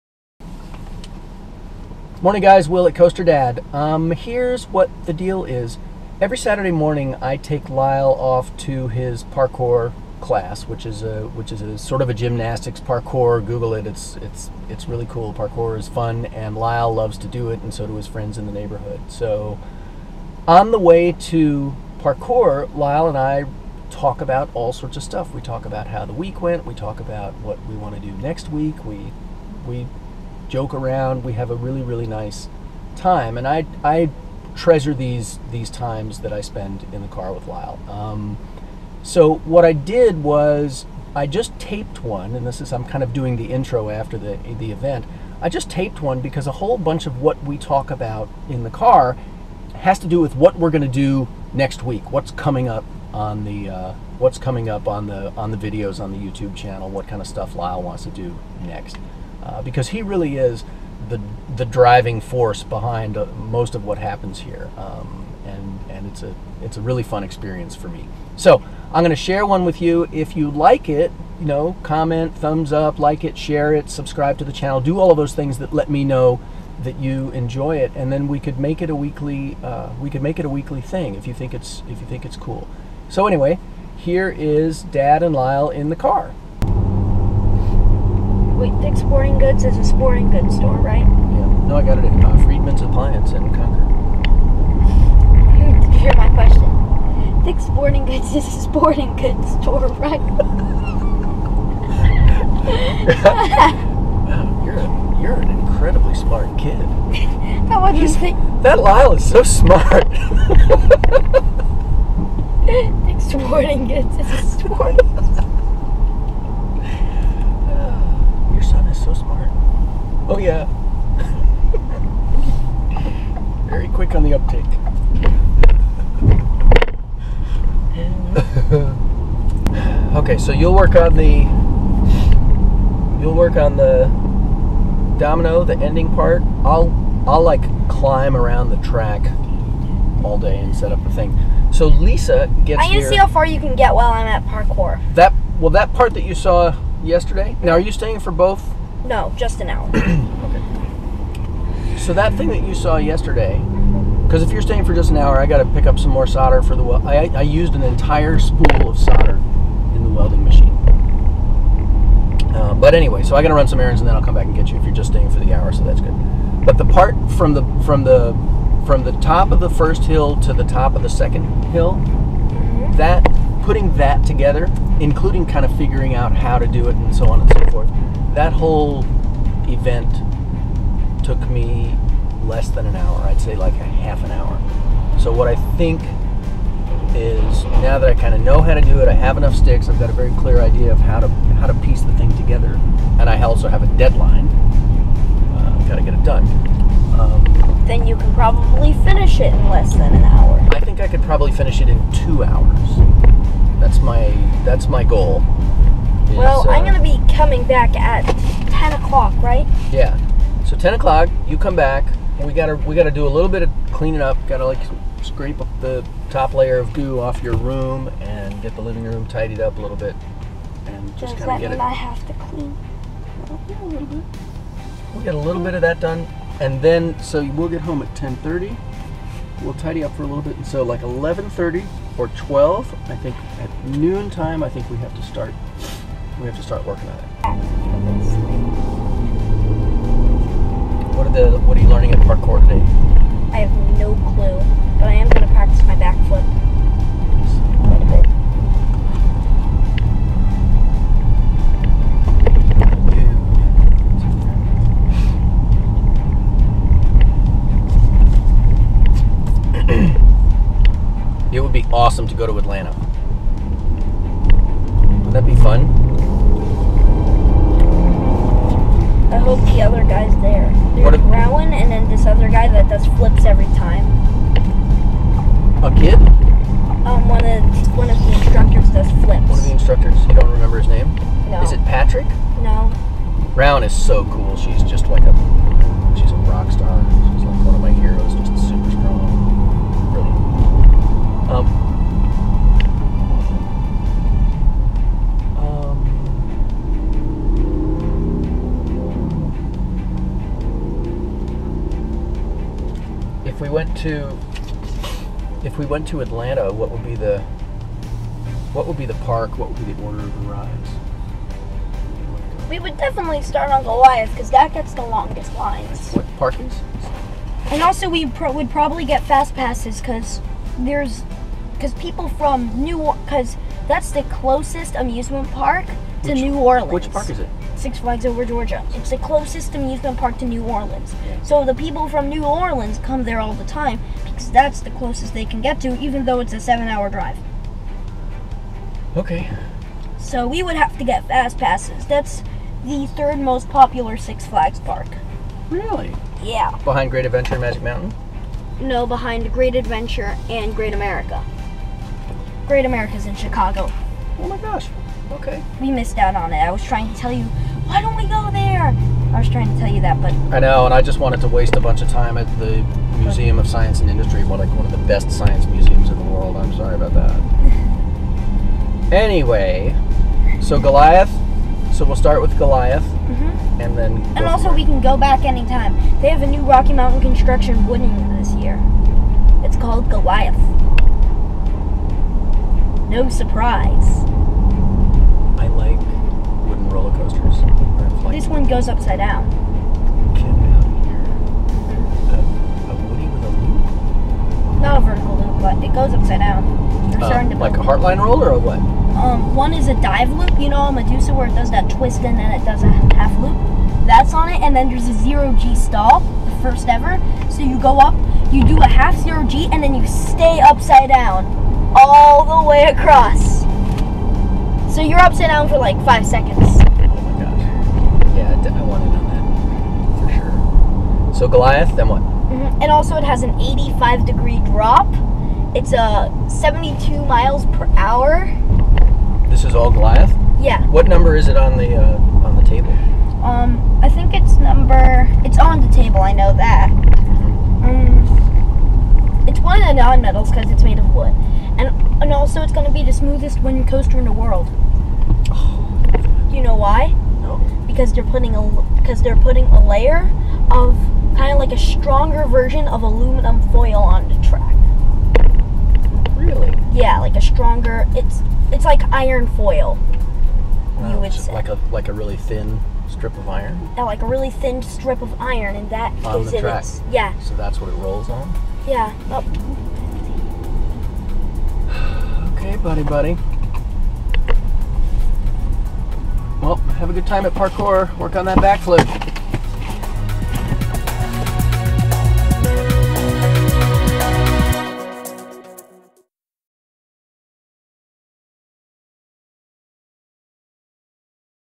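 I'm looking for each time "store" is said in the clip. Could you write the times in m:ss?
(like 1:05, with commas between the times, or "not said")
1:30, 1:39.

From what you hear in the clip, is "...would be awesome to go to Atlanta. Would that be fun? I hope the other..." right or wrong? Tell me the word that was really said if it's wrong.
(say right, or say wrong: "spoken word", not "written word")
right.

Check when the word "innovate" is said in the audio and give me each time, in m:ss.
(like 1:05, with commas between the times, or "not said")
not said.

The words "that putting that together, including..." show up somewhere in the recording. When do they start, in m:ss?
2:52.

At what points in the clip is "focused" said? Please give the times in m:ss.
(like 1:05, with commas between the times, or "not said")
not said.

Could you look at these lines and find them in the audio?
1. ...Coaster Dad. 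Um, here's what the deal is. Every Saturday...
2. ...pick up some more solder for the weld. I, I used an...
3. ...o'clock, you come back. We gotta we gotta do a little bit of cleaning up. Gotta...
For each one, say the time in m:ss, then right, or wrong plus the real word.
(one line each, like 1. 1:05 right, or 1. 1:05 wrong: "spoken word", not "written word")
1. 0:02 right
2. 2:35 right
3. 3:30 right.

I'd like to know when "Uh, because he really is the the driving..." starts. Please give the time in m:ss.
0:59.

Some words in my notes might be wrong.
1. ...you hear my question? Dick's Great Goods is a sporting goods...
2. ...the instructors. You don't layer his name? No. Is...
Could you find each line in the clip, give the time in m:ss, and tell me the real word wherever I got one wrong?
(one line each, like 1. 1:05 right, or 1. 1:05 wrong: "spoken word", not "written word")
1. 1:35 wrong: "Sporting", not "Great"
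2. 4:39 wrong: "remember", not "layer".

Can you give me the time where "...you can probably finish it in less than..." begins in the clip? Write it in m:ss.
3:18.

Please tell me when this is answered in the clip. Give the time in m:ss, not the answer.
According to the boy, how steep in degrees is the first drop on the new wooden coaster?
7:03.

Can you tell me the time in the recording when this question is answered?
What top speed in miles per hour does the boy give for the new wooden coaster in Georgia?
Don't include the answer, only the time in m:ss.
7:06.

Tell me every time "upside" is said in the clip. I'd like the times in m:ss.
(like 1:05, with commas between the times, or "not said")
6:28, 6:36, 6:50, 6:55.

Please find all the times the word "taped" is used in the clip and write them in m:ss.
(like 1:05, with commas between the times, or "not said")
0:41, 0:45.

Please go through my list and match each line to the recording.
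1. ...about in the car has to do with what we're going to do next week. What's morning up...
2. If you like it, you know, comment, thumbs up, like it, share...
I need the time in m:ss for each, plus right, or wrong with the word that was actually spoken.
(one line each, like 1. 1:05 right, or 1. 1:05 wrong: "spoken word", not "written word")
1. 0:47 wrong: "coming", not "morning"
2. 1:10 right.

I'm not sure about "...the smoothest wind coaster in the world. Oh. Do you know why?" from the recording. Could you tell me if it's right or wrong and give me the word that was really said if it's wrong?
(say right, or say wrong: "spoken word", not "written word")
right.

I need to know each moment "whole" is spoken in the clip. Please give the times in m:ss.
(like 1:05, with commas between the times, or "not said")
0:46, 2:58.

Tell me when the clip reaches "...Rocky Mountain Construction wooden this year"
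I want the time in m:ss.
6:16.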